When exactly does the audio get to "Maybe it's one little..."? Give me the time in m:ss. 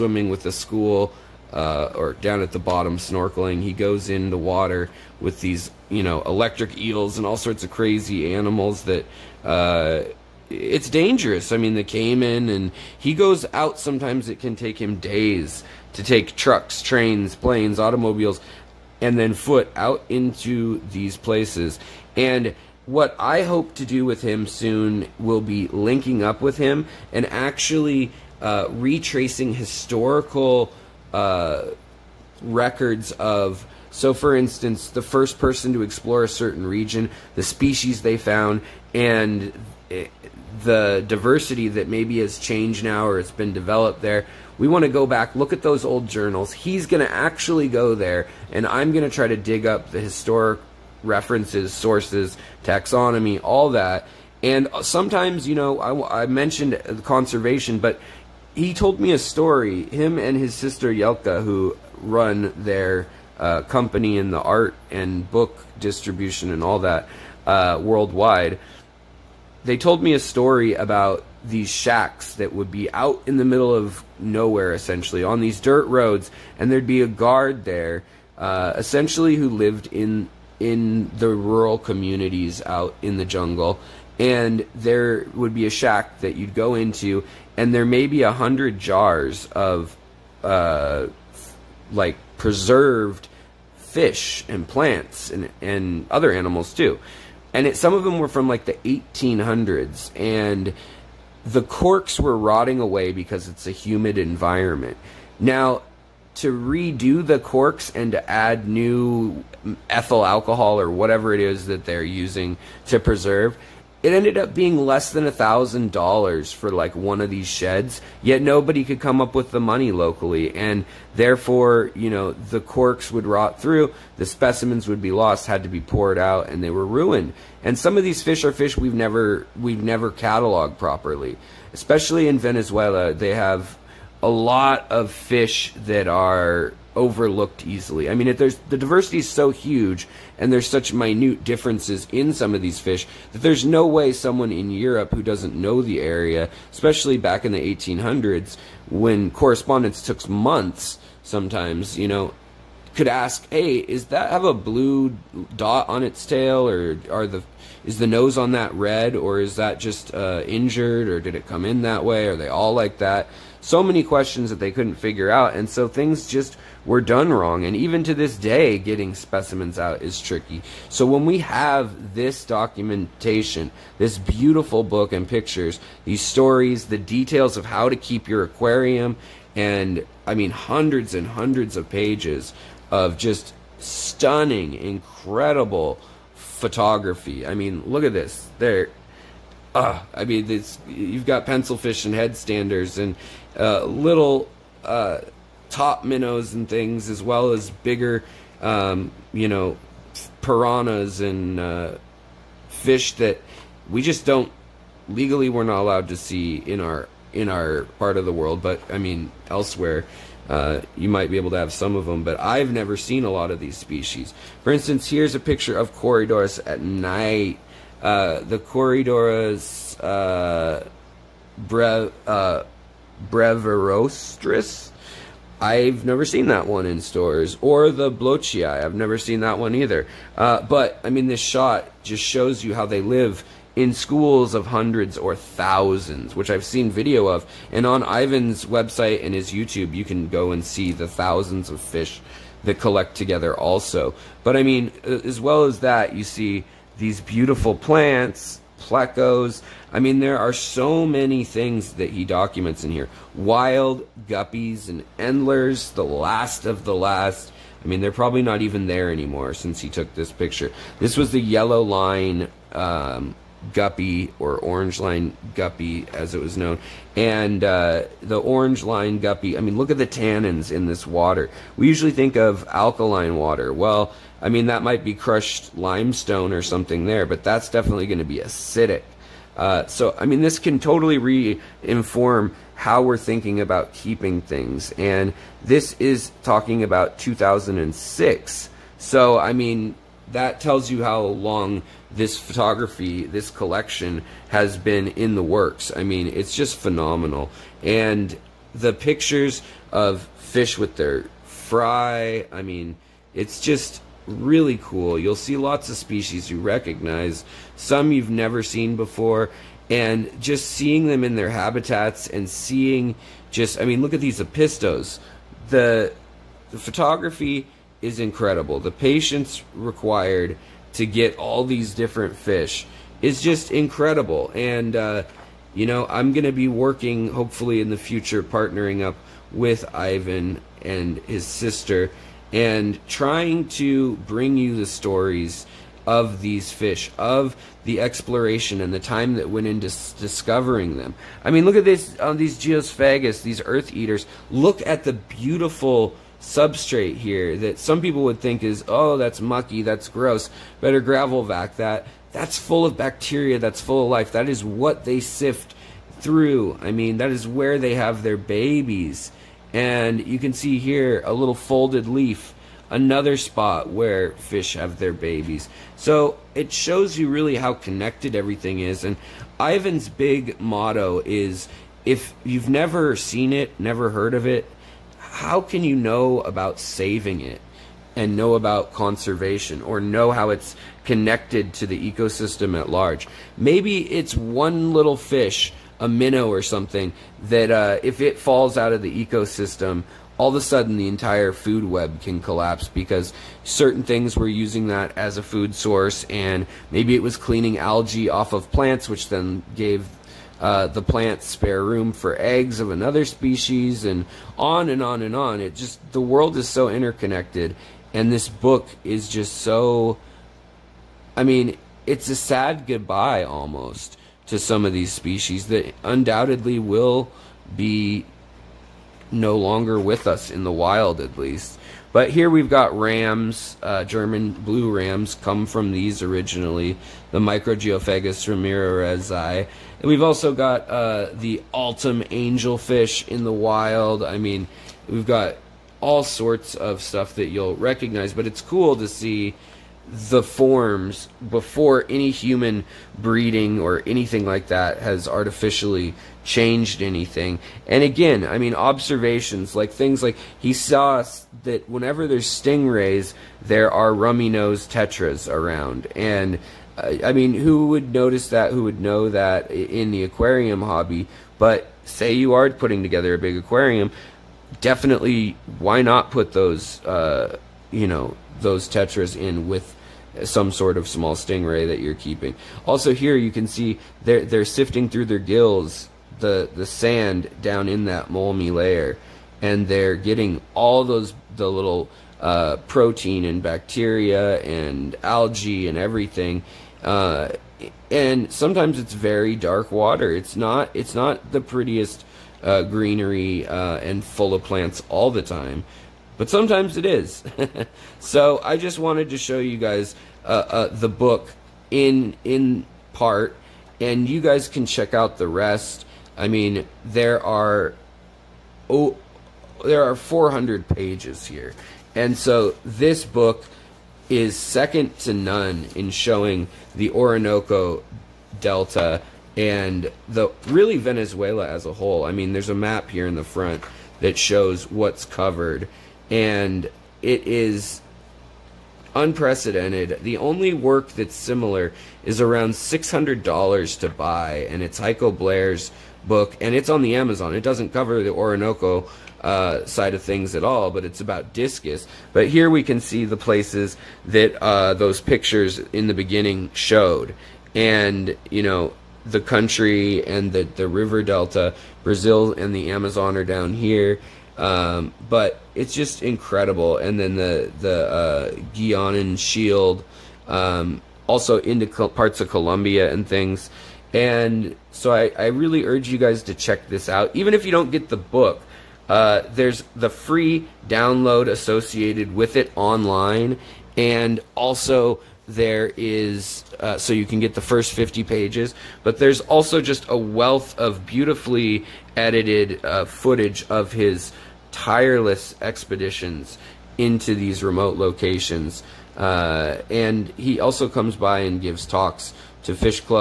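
6:23.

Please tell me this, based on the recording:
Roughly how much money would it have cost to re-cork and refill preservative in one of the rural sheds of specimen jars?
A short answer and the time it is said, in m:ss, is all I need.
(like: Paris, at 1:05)
less than $1,000, at 1:54.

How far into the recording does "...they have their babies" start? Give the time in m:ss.
5:57.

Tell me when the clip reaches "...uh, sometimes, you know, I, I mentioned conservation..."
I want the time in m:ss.
0:54.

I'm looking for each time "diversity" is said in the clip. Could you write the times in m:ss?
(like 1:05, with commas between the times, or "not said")
0:41, 2:18.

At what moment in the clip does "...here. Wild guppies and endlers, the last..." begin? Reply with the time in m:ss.
4:12.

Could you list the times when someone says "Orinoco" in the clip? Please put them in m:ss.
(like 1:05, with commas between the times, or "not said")
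8:37, 8:58.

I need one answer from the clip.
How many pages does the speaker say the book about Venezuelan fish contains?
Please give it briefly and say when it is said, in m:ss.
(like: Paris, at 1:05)
400, at 8:30.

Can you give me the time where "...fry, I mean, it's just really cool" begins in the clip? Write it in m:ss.
5:01.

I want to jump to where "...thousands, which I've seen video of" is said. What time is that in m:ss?
3:55.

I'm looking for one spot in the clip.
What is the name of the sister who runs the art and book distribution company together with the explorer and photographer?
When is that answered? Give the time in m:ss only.
1:00.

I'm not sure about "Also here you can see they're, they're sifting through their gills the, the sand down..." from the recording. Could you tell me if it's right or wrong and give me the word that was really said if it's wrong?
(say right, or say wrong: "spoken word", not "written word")
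right.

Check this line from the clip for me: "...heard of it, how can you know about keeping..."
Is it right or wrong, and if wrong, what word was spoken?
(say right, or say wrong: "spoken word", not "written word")
wrong: "saving", not "keeping".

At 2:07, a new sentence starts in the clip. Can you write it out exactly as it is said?
And some of these fish are fish we've never we've never cataloged properly, especially in Venezuela.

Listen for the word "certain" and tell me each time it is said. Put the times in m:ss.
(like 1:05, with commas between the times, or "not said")
0:36, 6:33.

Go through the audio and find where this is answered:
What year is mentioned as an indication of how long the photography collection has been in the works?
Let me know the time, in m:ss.
4:47.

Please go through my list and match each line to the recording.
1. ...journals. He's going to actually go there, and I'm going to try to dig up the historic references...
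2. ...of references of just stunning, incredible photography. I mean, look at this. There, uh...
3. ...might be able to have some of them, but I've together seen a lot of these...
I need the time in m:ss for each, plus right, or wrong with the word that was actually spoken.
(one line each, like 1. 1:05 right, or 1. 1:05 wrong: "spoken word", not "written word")
1. 0:46 right
2. 3:01 wrong: "pages", not "references"
3. 3:31 wrong: "never", not "together".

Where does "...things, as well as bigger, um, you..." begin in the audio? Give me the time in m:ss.
3:16.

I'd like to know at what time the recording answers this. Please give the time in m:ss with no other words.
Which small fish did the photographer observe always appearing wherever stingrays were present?
7:34.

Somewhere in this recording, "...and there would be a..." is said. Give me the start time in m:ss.
1:24.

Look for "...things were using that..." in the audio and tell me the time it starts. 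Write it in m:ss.
6:34.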